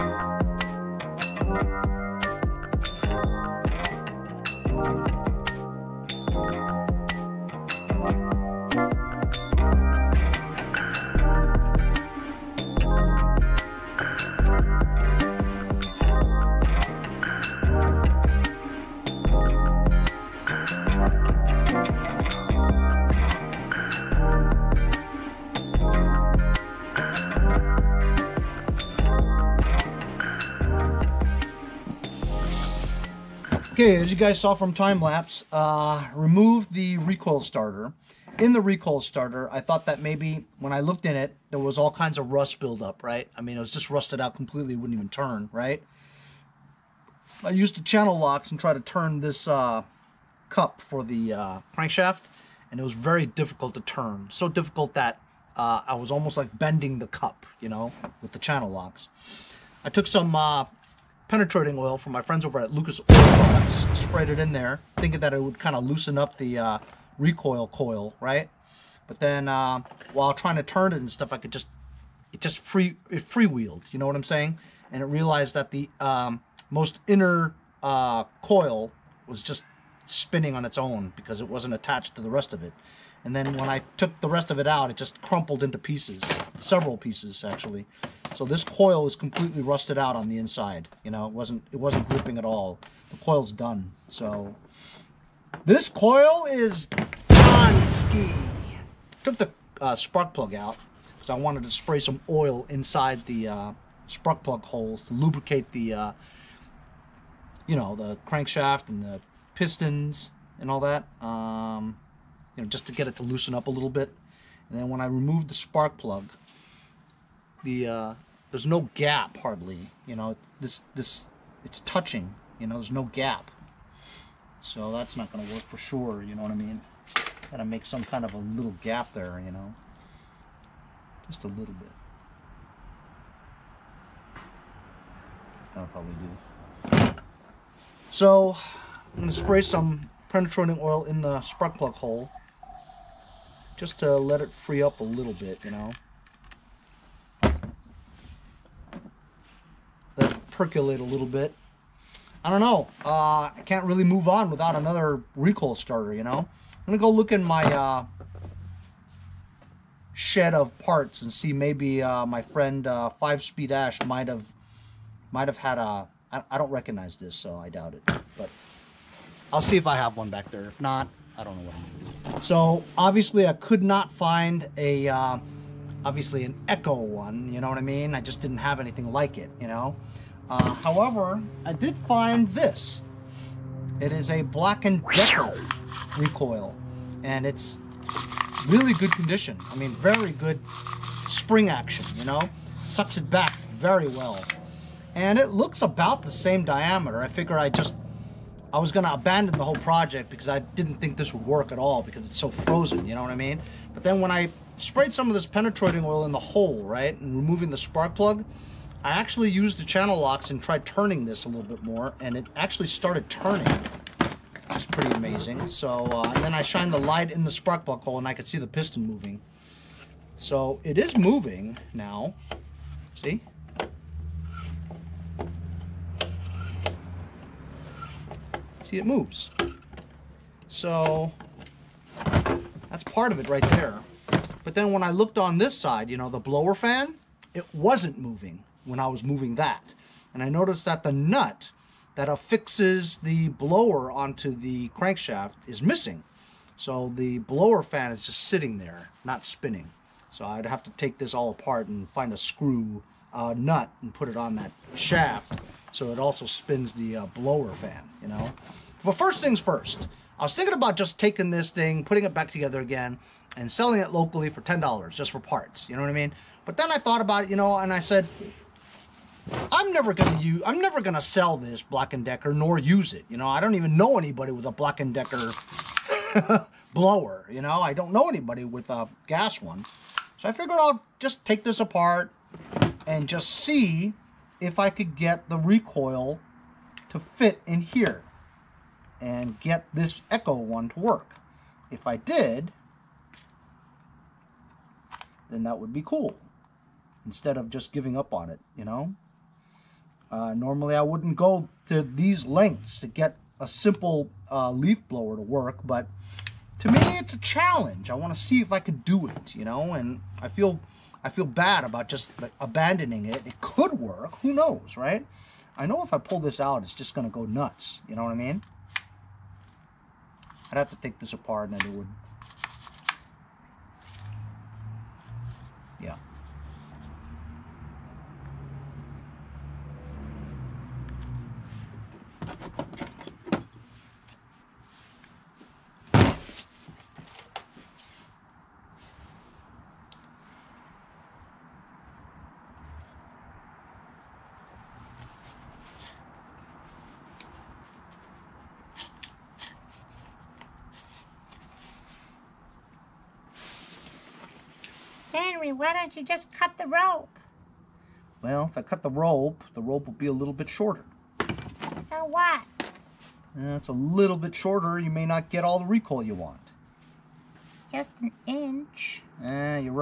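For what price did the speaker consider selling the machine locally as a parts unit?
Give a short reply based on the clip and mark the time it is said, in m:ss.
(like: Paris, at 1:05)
$10, at 4:24.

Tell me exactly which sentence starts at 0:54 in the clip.
So difficult that uh, I was almost like bending the cup, you know, with the channel locks.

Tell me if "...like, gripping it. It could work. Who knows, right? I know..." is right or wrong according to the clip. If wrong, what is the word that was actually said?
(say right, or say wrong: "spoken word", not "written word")
wrong: "abandoning", not "gripping".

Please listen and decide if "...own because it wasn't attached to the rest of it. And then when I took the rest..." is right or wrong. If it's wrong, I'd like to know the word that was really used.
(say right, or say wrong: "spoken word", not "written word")
right.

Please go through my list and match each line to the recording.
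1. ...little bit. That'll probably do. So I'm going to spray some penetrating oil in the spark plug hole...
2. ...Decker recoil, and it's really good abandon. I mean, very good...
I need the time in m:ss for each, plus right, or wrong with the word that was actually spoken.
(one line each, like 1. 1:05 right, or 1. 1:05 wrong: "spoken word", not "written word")
1. 2:11 right
2. 3:05 wrong: "condition", not "abandon".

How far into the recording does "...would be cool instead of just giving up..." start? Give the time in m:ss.
4:55.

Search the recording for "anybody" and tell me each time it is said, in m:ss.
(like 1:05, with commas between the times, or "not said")
4:34, 4:38.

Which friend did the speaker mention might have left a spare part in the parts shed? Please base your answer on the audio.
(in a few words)
Five Speed Ash.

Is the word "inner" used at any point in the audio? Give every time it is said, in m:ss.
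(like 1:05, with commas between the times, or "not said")
1:17.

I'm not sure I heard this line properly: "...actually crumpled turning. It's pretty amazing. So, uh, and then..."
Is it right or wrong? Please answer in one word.
wrong.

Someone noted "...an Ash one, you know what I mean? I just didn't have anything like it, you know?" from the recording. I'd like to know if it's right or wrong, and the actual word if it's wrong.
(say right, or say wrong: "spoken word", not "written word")
wrong: "Echo", not "Ash".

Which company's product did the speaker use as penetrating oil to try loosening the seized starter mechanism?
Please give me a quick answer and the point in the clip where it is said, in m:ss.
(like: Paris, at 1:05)
Lucas Oil, at 1:02.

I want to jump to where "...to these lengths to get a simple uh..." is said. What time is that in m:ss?
5:01.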